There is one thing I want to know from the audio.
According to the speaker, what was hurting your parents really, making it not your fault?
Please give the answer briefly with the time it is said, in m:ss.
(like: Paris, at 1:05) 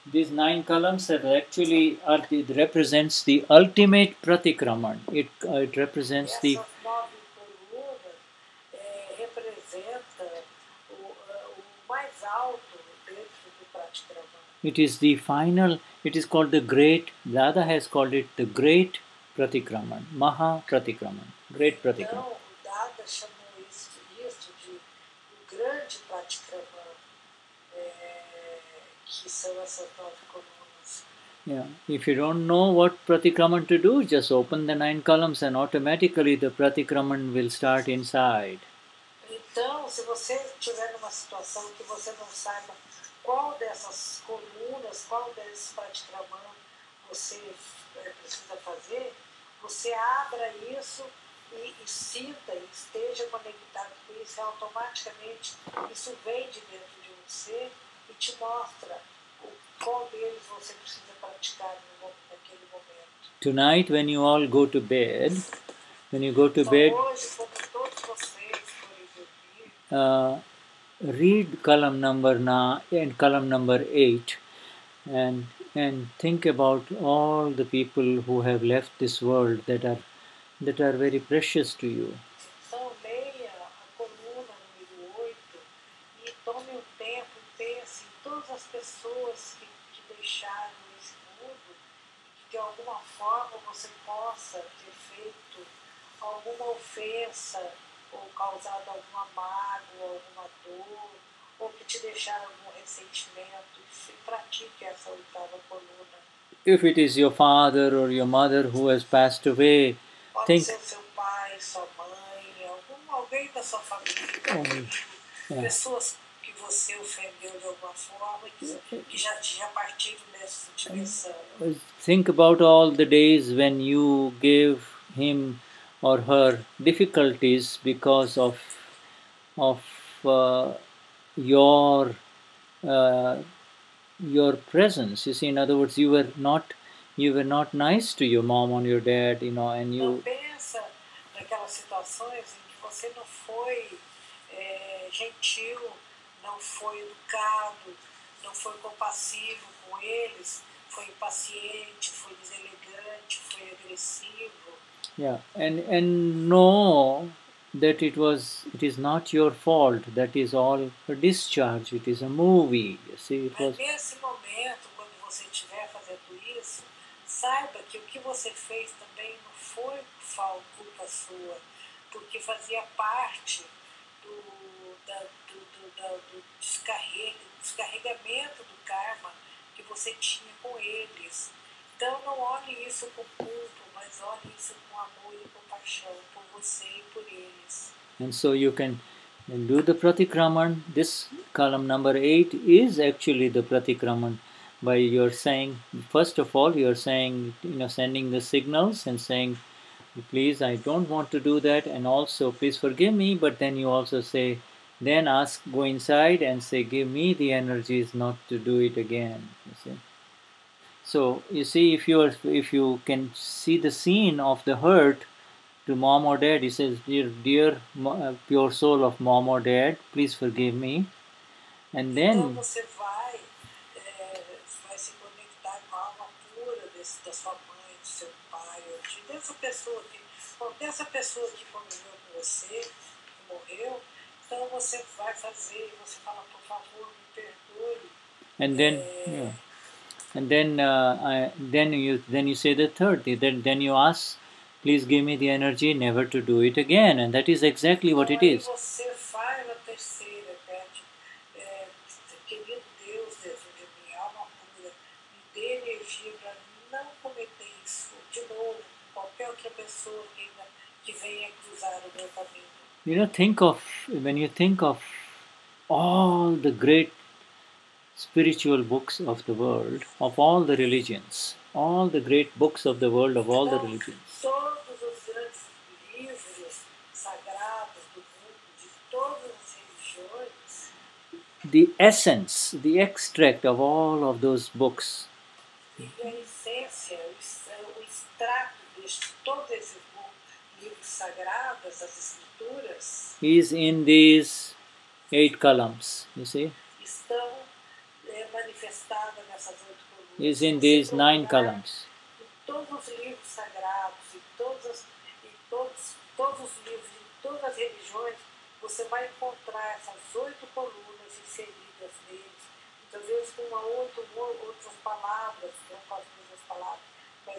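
a discharge, at 2:41.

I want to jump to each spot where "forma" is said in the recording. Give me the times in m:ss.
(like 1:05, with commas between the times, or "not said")
1:57.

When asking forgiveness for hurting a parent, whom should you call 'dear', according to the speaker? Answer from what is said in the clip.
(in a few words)
pure soul of mom or dad.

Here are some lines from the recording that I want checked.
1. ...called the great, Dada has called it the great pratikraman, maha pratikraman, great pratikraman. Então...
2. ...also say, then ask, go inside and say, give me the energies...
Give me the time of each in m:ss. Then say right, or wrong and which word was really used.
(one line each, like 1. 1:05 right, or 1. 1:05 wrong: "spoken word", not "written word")
1. 0:16 right
2. 3:23 right.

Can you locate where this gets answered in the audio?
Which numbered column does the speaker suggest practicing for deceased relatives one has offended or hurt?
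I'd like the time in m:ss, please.
1:45.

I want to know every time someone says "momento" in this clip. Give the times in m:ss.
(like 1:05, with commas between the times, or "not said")
1:02, 2:44.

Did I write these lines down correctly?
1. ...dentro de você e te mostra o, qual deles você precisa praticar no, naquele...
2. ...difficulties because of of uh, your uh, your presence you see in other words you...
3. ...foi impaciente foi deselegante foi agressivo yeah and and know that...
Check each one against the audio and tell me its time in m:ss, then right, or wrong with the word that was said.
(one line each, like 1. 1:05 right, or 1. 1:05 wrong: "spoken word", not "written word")
1. 0:56 right
2. 2:06 right
3. 2:30 right.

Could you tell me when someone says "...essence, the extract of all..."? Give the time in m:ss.
4:41.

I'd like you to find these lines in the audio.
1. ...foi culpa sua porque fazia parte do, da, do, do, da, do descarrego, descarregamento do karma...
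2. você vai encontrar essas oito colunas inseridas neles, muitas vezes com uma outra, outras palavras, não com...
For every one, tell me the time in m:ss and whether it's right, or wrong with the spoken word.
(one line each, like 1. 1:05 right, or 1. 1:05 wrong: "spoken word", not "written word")
1. 2:49 right
2. 5:08 right.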